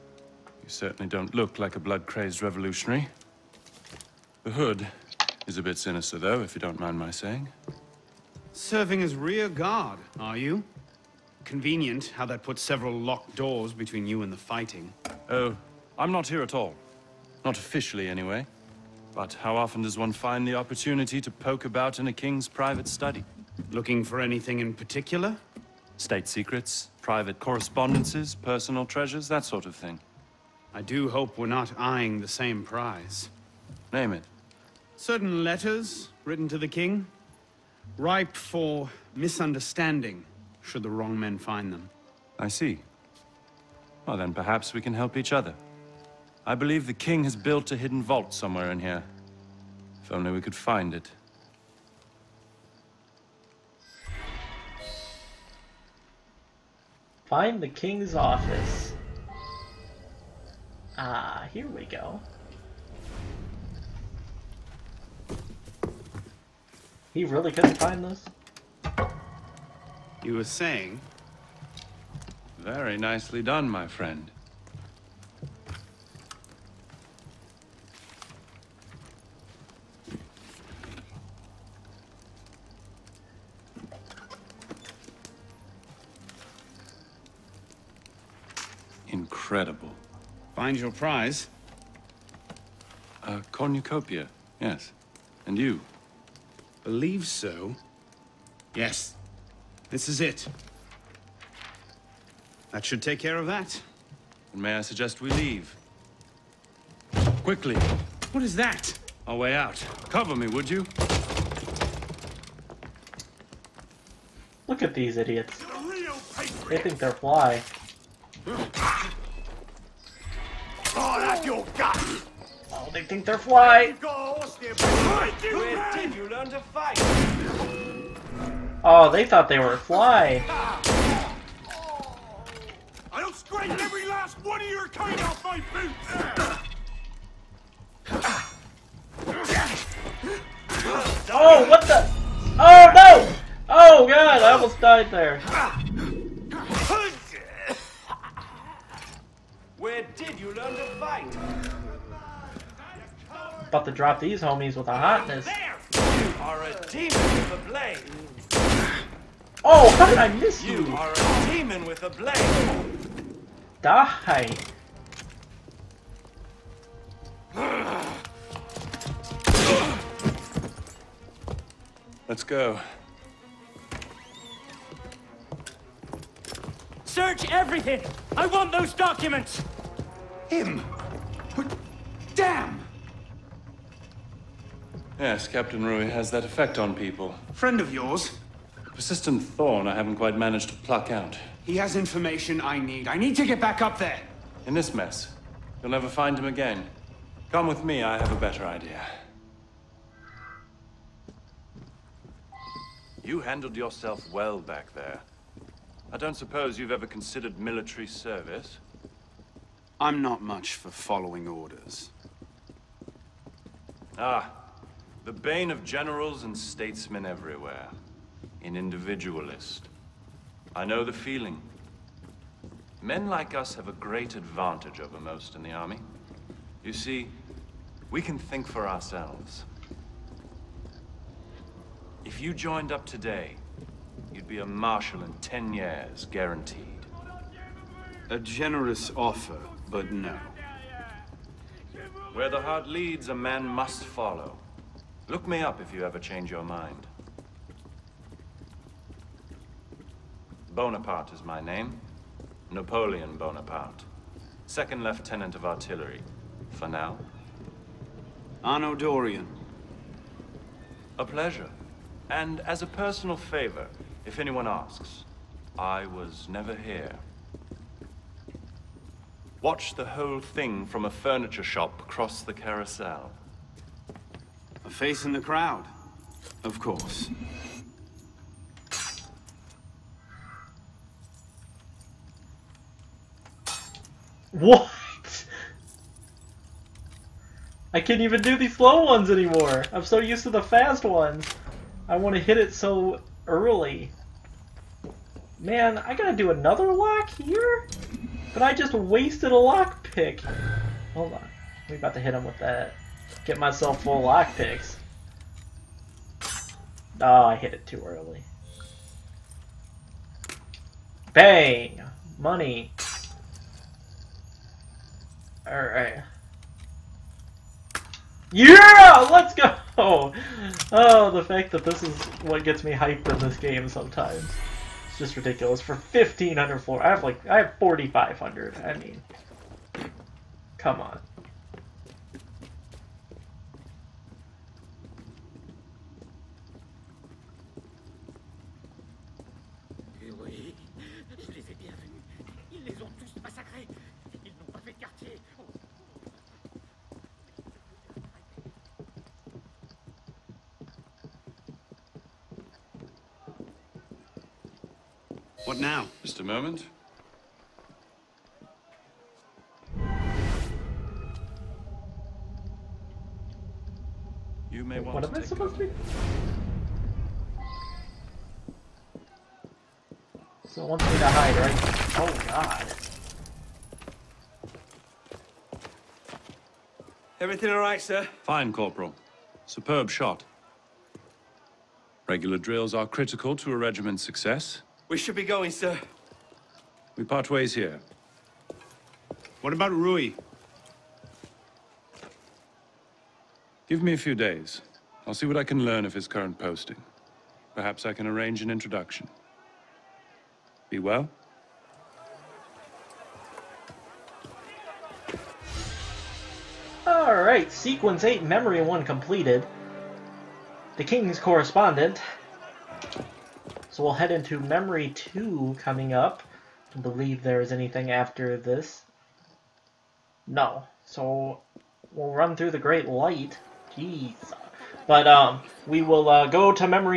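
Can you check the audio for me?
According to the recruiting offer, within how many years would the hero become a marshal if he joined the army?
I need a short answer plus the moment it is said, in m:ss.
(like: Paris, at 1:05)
10, at 3:55.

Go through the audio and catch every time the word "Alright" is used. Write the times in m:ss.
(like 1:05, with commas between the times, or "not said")
5:15, 6:47.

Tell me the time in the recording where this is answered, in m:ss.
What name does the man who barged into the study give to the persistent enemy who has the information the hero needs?
3:05.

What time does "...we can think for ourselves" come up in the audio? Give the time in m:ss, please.
3:48.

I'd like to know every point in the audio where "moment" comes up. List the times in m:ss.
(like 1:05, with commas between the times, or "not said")
5:56.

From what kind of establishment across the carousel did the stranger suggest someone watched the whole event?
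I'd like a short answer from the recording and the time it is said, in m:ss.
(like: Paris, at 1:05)
A furniture shop, at 4:31.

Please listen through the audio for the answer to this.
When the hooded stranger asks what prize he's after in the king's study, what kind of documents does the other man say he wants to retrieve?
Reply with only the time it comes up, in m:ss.
0:34.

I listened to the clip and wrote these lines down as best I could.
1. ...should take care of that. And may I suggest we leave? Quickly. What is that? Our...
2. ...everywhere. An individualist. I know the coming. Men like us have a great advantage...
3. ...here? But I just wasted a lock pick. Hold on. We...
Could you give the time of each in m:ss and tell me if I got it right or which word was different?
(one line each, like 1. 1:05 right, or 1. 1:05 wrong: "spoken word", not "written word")
1. 1:42 right
2. 3:37 wrong: "feeling", not "coming"
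3. 4:57 right.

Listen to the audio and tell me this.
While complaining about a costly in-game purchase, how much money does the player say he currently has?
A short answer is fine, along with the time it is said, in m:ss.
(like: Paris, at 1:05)
4,500, at 5:27.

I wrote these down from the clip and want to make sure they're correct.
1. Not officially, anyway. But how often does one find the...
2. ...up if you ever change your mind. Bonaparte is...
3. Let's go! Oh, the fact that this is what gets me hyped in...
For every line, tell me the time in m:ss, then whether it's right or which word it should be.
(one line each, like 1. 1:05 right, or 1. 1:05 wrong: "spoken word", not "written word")
1. 0:17 right
2. 4:05 right
3. 5:19 right.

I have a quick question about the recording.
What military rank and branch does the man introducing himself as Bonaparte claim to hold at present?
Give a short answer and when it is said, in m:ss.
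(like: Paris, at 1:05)
Second Lieutenant of Artillery, at 4:14.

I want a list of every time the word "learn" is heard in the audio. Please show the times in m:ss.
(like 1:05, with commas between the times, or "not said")
2:30, 6:35.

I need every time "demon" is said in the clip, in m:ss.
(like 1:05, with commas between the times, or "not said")
2:36, 2:41.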